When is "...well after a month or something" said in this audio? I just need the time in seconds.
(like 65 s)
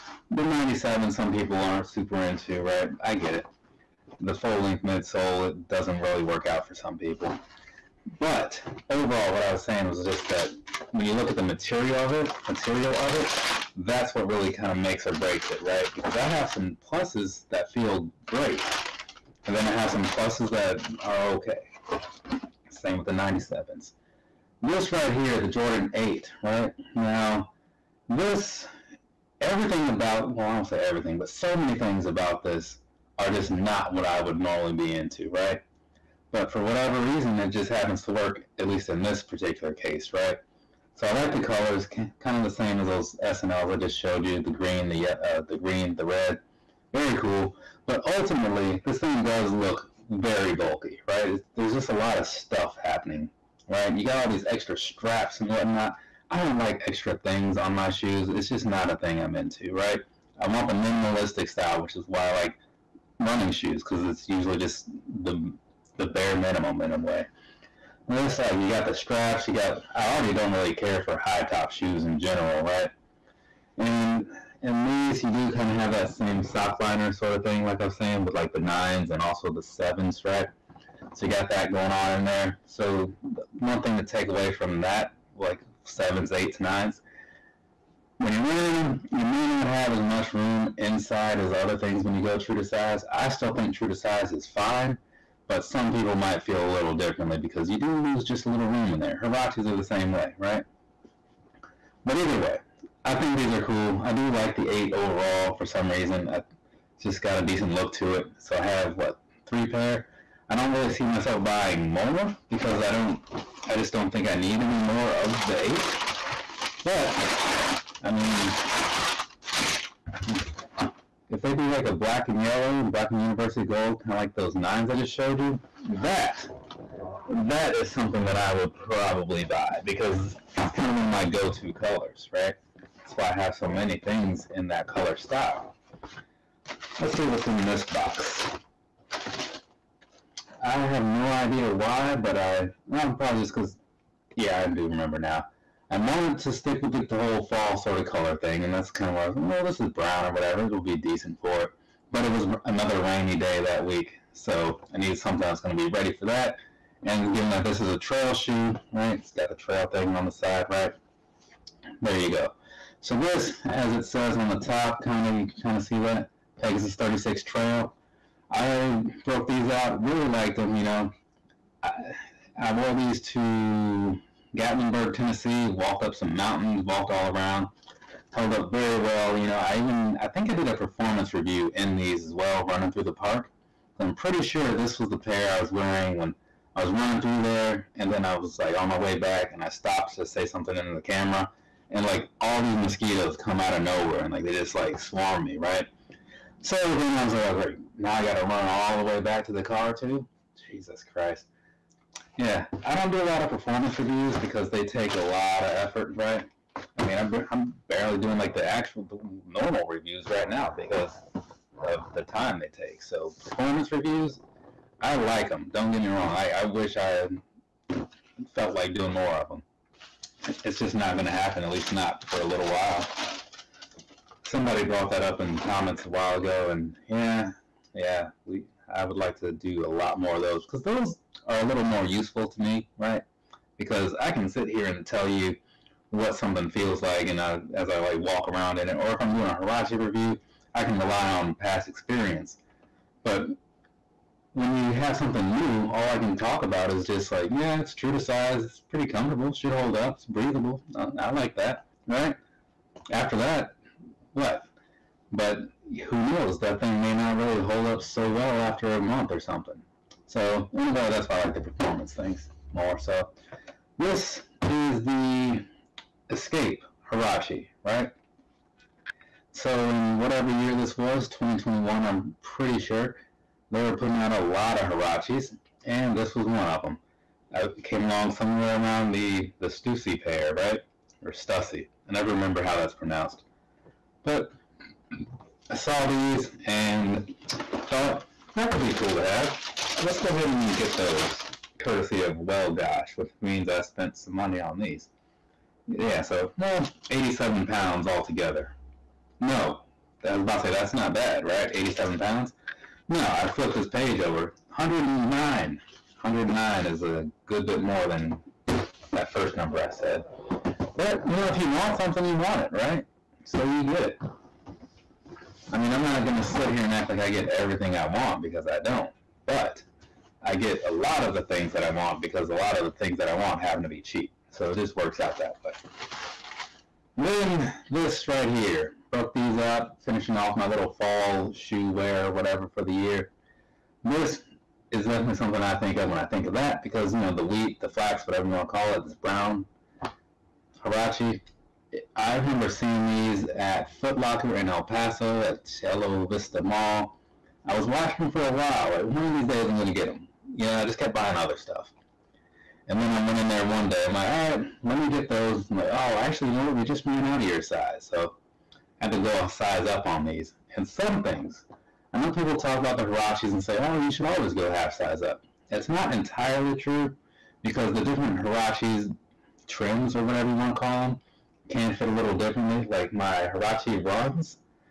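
258 s.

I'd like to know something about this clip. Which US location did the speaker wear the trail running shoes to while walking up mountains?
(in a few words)
Gatlinburg, Tennessee.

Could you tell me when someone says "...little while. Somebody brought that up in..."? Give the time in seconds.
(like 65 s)
222 s.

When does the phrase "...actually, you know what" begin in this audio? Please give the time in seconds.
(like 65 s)
356 s.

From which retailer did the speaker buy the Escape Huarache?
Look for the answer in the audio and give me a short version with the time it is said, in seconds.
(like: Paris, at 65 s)
Wellgosh, at 292 s.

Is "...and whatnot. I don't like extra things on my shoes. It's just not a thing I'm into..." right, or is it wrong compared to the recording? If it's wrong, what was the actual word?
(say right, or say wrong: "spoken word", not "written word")
right.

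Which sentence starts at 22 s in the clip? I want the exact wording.
Same with the 97s this right here, the Jordan 8, right?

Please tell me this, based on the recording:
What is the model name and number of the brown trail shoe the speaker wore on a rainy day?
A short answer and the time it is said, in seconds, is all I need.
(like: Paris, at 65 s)
Pegasus 36 Trail, at 166 s.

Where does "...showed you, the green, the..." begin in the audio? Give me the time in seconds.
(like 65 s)
43 s.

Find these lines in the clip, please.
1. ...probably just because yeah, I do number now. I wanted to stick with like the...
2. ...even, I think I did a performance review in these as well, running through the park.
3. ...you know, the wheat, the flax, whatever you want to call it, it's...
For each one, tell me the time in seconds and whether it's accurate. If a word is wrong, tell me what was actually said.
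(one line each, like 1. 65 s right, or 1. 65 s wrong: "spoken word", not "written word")
1. 143 s wrong: "remember", not "number"
2. 179 s right
3. 337 s right.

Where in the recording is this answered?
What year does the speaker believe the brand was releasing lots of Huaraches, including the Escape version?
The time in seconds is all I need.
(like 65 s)
271 s.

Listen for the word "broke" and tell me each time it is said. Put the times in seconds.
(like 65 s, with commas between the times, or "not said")
169 s, 329 s.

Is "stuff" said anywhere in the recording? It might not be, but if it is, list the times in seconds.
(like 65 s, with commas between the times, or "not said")
52 s, 351 s.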